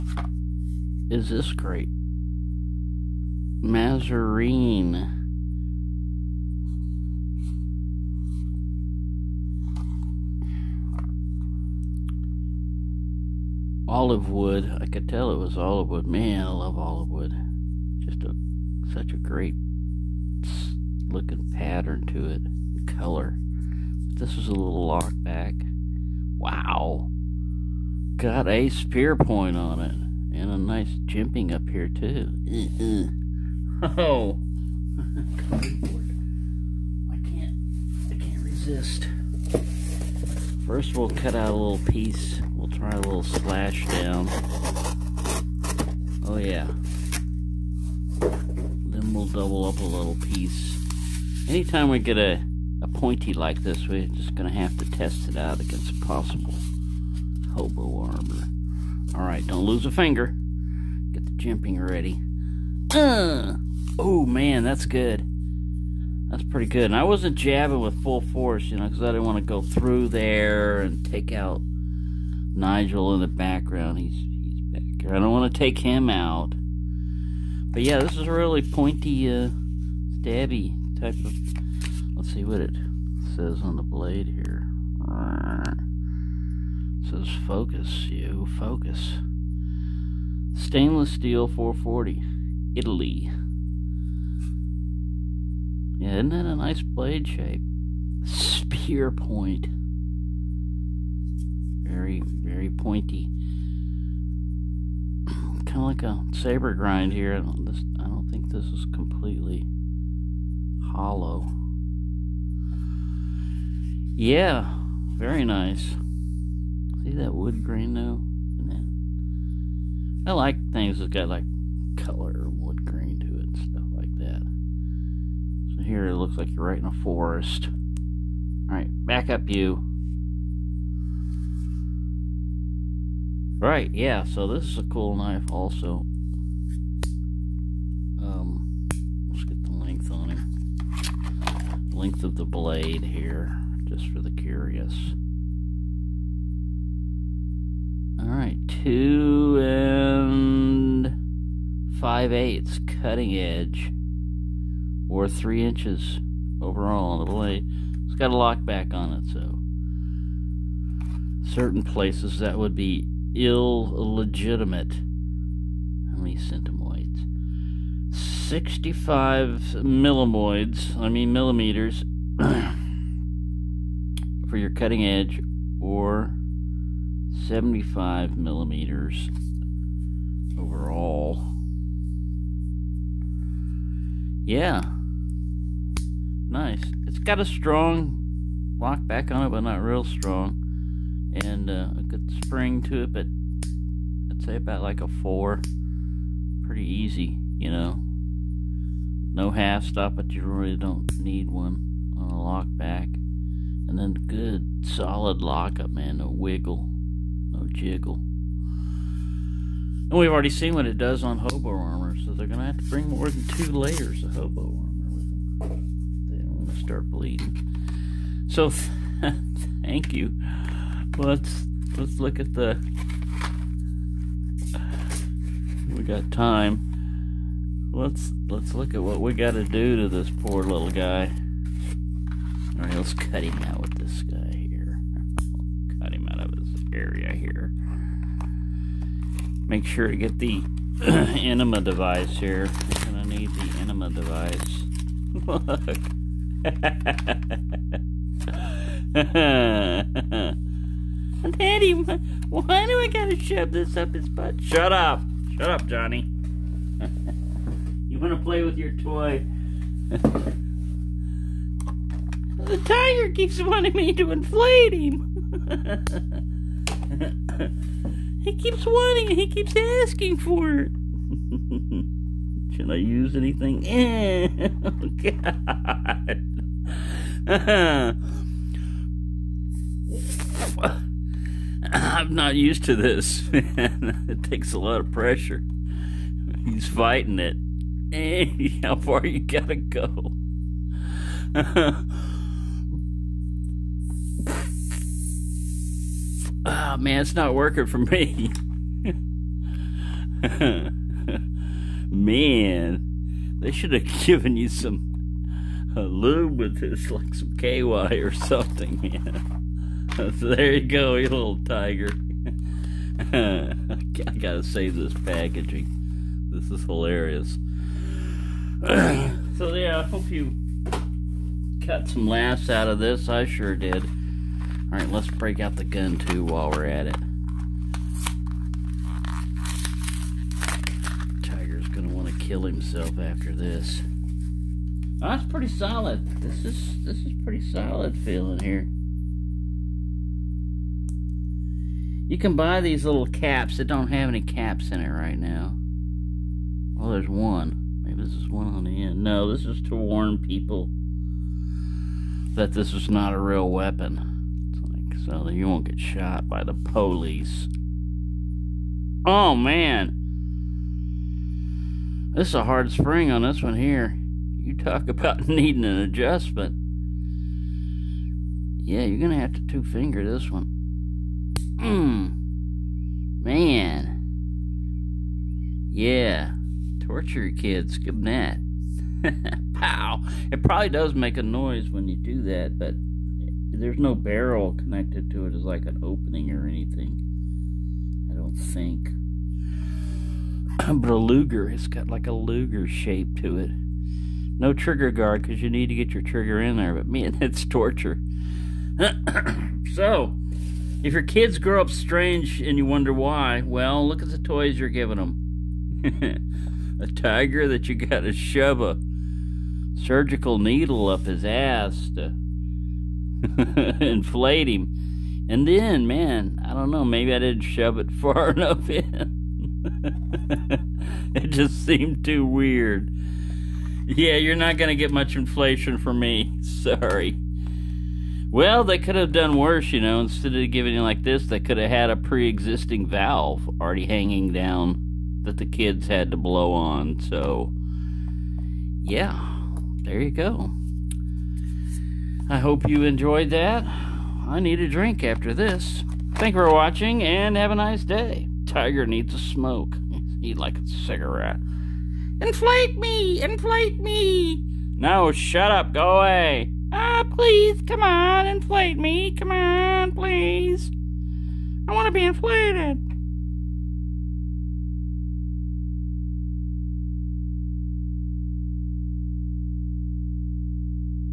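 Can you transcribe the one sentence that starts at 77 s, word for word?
But yeah, this is a really pointy, uh, stabby type of...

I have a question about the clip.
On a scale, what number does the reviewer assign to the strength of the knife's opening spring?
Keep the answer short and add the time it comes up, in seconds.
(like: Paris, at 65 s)
4, at 195 s.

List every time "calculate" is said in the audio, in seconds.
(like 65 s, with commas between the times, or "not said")
not said.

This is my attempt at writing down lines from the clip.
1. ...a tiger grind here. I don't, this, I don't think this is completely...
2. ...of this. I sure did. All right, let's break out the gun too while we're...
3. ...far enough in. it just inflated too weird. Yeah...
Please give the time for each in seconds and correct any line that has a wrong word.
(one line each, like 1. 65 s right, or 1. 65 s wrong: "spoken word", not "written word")
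1. 106 s wrong: "saber", not "tiger"
2. 322 s right
3. 418 s wrong: "seemed", not "inflated".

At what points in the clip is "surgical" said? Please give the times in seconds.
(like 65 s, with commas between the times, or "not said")
409 s.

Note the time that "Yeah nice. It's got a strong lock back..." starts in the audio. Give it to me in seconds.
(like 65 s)
184 s.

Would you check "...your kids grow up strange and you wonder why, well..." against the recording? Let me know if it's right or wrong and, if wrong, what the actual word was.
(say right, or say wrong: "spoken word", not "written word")
right.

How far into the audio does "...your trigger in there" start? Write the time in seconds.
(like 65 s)
396 s.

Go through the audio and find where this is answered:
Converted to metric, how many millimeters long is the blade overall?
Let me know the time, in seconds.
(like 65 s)
177 s.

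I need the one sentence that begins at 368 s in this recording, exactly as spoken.
Yeah, you're going to have to two-finger this one.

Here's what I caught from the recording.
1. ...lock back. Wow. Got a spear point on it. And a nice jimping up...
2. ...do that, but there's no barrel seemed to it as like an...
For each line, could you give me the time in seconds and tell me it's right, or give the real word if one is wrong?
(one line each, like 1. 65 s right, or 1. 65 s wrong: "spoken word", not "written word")
1. 24 s right
2. 382 s wrong: "connected", not "seemed".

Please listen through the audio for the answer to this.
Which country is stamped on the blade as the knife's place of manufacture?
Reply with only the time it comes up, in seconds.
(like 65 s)
92 s.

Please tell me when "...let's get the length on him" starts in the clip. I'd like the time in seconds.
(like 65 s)
139 s.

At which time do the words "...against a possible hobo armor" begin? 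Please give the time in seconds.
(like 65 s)
55 s.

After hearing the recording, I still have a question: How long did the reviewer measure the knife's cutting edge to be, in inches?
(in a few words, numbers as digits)
2 5/8 inches.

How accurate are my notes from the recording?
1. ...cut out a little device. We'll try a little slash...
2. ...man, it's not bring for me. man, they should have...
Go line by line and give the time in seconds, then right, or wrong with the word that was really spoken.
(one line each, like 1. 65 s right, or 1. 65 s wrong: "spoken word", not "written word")
1. 41 s wrong: "piece", not "device"
2. 296 s wrong: "working", not "bring".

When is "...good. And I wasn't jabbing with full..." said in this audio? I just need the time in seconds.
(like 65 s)
66 s.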